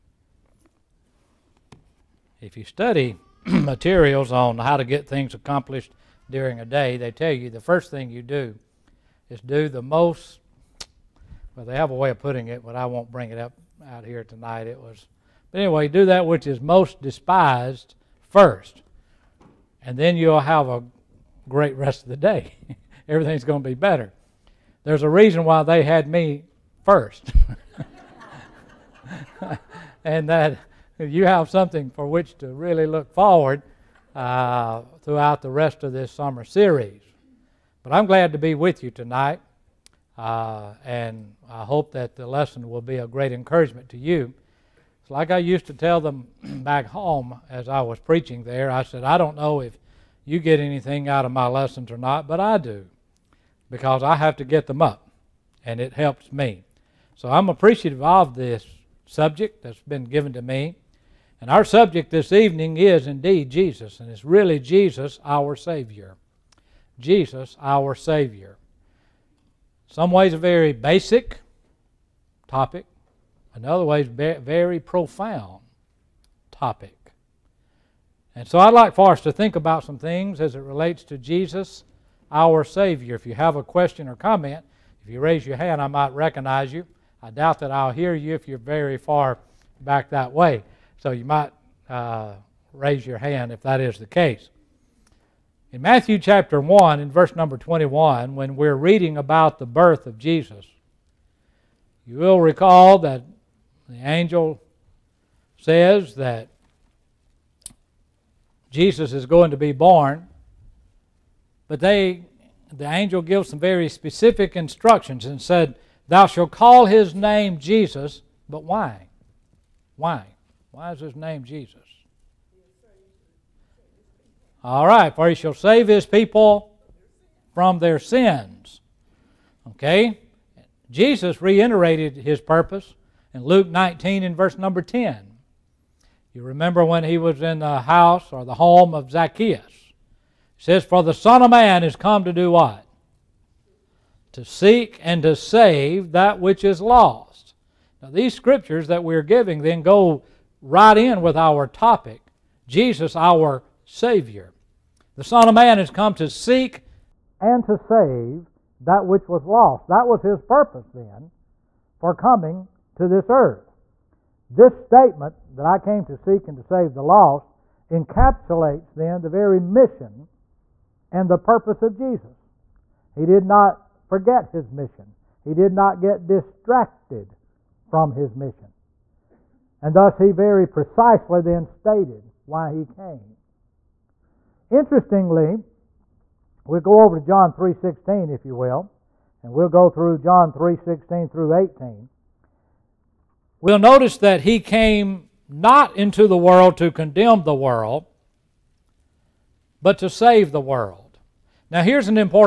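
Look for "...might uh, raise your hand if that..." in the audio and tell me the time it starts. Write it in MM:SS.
01:31.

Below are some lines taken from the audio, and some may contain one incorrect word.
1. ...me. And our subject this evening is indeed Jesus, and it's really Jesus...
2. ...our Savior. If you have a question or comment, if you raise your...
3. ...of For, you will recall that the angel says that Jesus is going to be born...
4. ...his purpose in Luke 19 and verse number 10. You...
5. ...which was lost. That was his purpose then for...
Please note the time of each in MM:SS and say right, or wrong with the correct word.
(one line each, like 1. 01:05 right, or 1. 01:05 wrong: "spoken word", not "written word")
1. 01:00 right
2. 01:22 right
3. 01:40 wrong: "Jesus", not "For"
4. 02:12 right
5. 02:39 right.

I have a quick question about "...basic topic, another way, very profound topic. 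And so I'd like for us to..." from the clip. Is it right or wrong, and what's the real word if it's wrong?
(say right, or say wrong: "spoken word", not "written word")
right.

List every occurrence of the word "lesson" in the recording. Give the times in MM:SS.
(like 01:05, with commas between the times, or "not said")
00:42, 00:51.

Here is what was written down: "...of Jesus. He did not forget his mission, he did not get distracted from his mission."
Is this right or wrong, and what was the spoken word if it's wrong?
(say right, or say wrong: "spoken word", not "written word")
right.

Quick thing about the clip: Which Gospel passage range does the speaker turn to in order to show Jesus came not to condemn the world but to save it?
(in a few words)
John 3:16-18.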